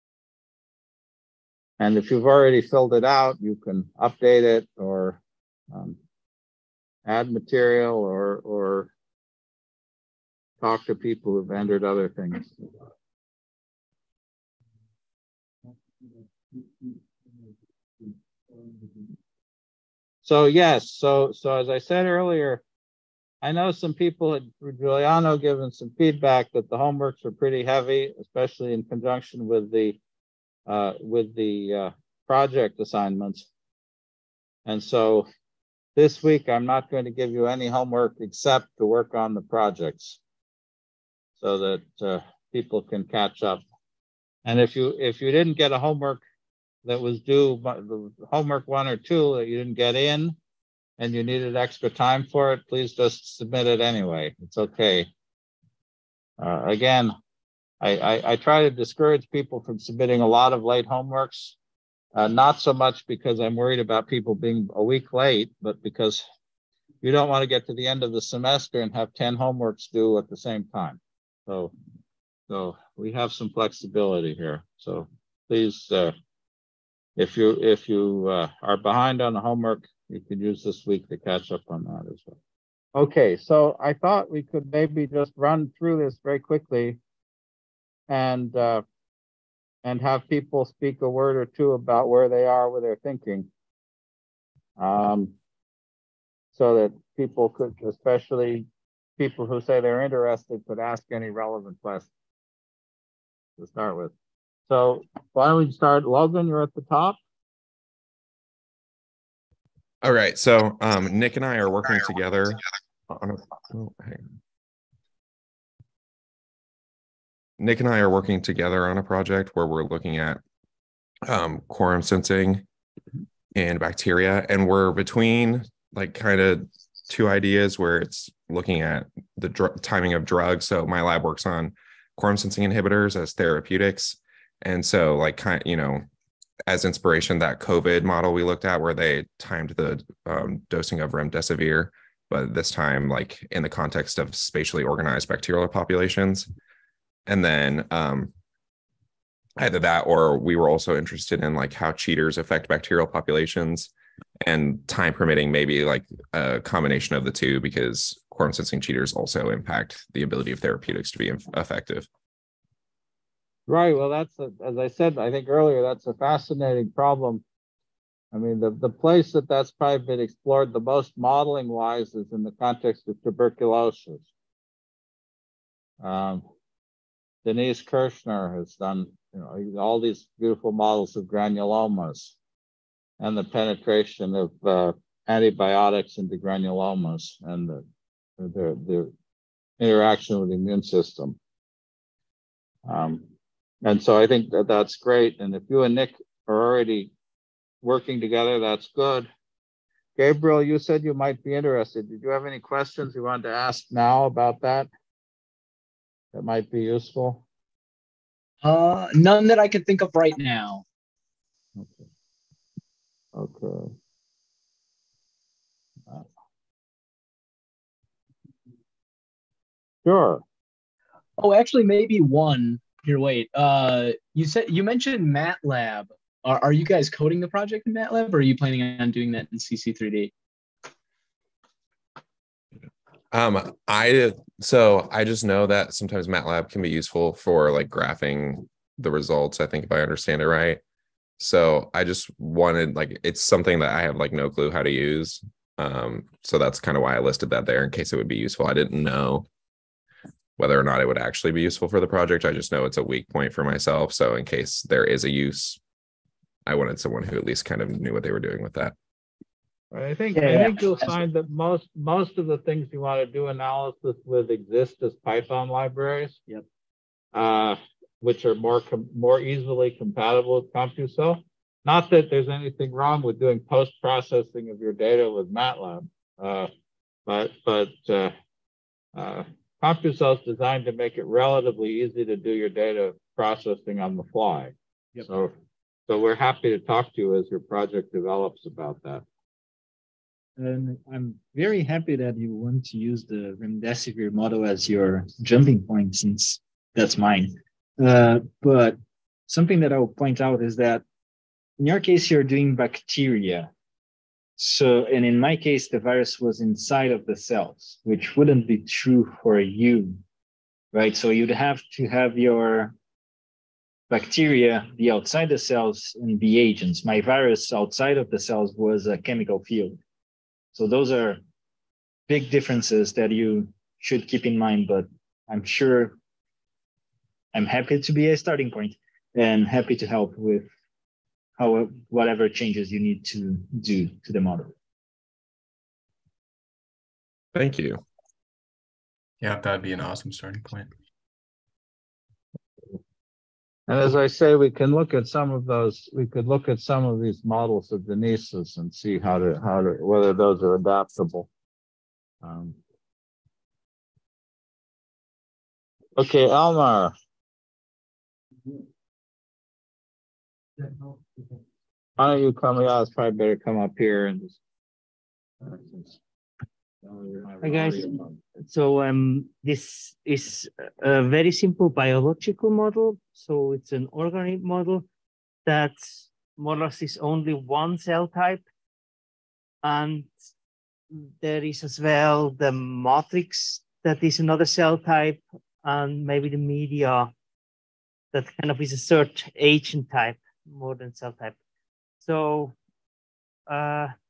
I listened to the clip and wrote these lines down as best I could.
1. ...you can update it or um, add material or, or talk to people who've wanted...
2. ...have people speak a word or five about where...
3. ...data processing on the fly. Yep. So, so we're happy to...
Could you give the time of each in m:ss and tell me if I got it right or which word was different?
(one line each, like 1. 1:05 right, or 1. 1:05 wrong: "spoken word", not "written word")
1. 0:03 wrong: "entered", not "wanted"
2. 1:30 wrong: "two", not "five"
3. 4:42 right.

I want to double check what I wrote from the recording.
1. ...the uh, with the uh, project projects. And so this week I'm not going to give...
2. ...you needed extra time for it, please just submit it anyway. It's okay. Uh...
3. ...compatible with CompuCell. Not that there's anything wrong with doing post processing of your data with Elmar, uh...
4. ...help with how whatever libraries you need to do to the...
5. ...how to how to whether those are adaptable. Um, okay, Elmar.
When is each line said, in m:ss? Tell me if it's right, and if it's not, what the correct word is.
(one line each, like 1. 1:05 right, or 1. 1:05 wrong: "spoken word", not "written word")
1. 0:29 wrong: "assignments", not "projects"
2. 0:51 right
3. 4:29 wrong: "MATLAB", not "Elmar"
4. 5:30 wrong: "changes", not "libraries"
5. 5:49 right.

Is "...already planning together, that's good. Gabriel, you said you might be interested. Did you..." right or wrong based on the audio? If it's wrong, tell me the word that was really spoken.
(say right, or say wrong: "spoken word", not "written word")
wrong: "working", not "planning".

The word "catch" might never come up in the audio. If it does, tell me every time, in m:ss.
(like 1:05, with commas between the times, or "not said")
0:43, 1:21.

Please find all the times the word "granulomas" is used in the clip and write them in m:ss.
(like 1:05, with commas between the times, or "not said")
3:01, 3:06.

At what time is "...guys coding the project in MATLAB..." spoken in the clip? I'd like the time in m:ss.
3:46.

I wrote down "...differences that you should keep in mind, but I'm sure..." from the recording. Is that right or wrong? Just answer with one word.
right.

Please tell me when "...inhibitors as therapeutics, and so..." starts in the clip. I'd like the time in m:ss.
2:12.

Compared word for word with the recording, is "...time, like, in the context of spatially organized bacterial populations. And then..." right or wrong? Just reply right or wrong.
right.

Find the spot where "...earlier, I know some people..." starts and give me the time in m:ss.
0:22.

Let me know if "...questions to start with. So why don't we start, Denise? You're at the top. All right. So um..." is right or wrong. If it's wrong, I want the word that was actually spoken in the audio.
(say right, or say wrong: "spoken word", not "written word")
wrong: "Logan", not "Denise".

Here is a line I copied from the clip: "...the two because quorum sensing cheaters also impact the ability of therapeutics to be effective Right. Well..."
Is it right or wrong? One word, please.
right.